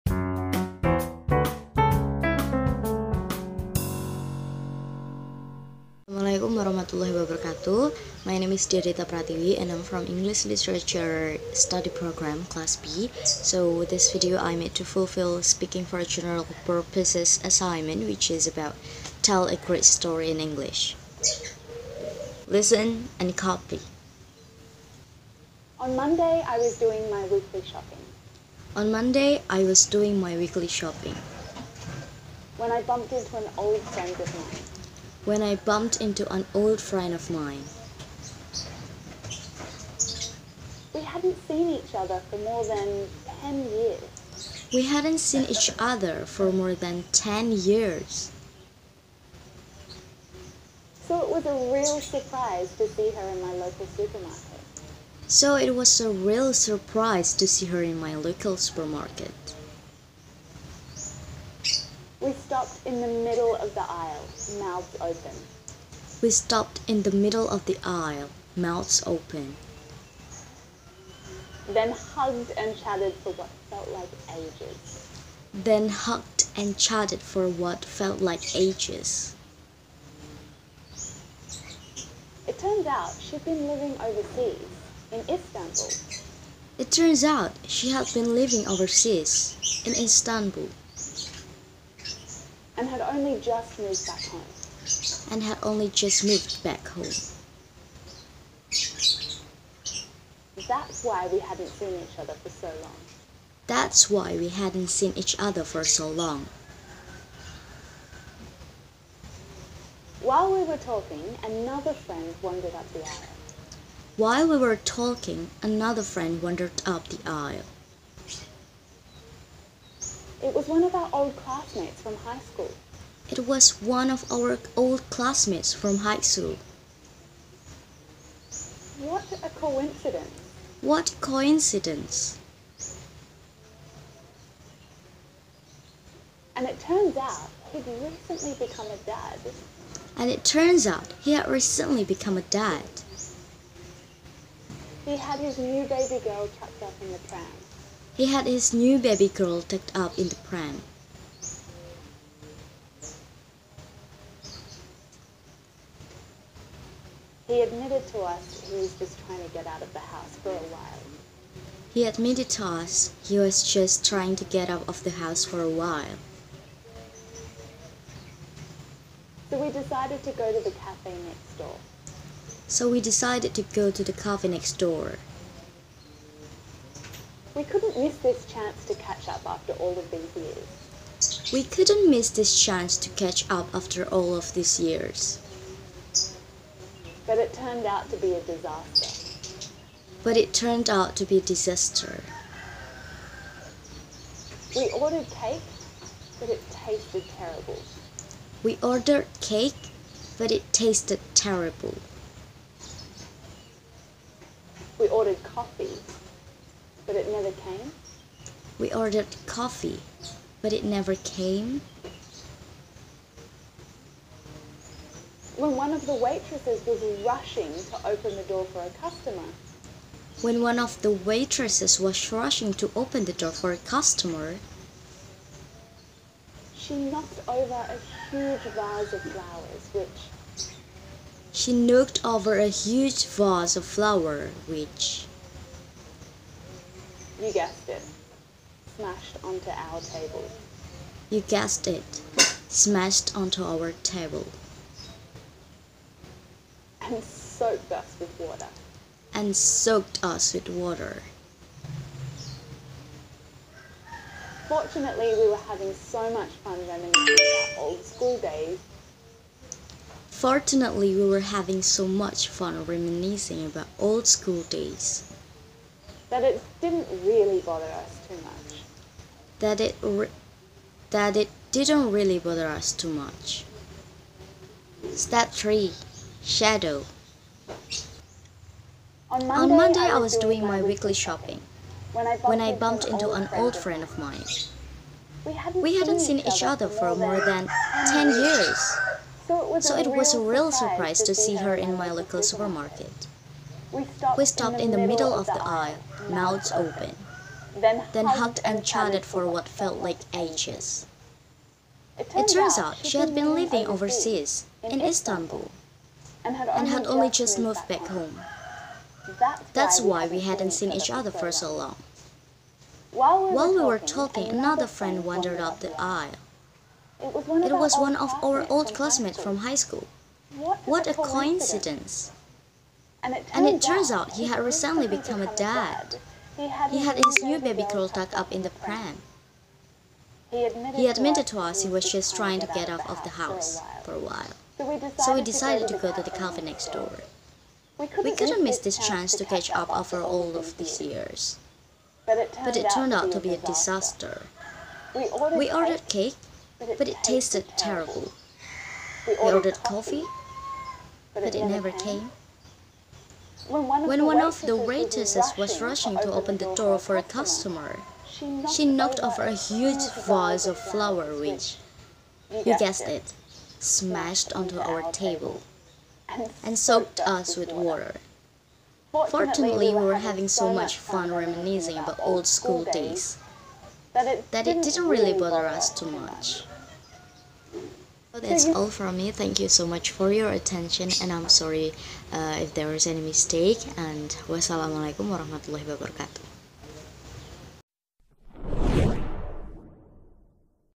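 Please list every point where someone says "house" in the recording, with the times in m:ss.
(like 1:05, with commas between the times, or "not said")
2:40, 2:45, 5:33.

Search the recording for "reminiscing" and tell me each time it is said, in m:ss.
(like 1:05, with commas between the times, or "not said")
4:16, 4:22, 6:11.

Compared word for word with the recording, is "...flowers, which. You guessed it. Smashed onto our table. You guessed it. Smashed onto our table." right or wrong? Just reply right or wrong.
right.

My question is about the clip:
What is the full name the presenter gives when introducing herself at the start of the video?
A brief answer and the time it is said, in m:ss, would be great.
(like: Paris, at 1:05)
Dyah Dita Pratiwi, at 0:08.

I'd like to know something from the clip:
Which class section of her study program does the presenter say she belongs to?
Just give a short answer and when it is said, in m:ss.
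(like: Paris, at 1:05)
Class B, at 0:12.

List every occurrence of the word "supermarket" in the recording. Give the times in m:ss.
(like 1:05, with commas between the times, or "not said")
0:53, 0:58, 4:52.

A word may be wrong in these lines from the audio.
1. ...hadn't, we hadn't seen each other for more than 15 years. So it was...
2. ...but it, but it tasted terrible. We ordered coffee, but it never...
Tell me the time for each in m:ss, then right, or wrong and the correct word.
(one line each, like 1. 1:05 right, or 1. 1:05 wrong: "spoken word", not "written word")
1. 4:45 wrong: "10", not "15"
2. 5:46 right.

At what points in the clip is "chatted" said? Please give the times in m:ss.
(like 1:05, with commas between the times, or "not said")
1:12, 1:16, 4:58.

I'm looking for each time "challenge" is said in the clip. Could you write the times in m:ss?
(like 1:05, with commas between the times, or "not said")
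not said.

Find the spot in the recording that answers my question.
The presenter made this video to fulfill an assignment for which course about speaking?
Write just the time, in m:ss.
0:15.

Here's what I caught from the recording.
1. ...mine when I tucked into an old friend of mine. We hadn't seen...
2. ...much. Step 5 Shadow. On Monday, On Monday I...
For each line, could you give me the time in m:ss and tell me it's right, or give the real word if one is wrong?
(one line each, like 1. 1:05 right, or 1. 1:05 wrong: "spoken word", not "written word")
1. 0:34 wrong: "bumped", not "tucked"
2. 4:33 wrong: "3", not "5".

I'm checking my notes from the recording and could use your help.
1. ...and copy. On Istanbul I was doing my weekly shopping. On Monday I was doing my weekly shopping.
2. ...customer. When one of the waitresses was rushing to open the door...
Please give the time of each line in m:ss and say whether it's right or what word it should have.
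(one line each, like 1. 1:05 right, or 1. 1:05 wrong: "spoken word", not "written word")
1. 0:23 wrong: "Monday", not "Istanbul"
2. 3:38 right.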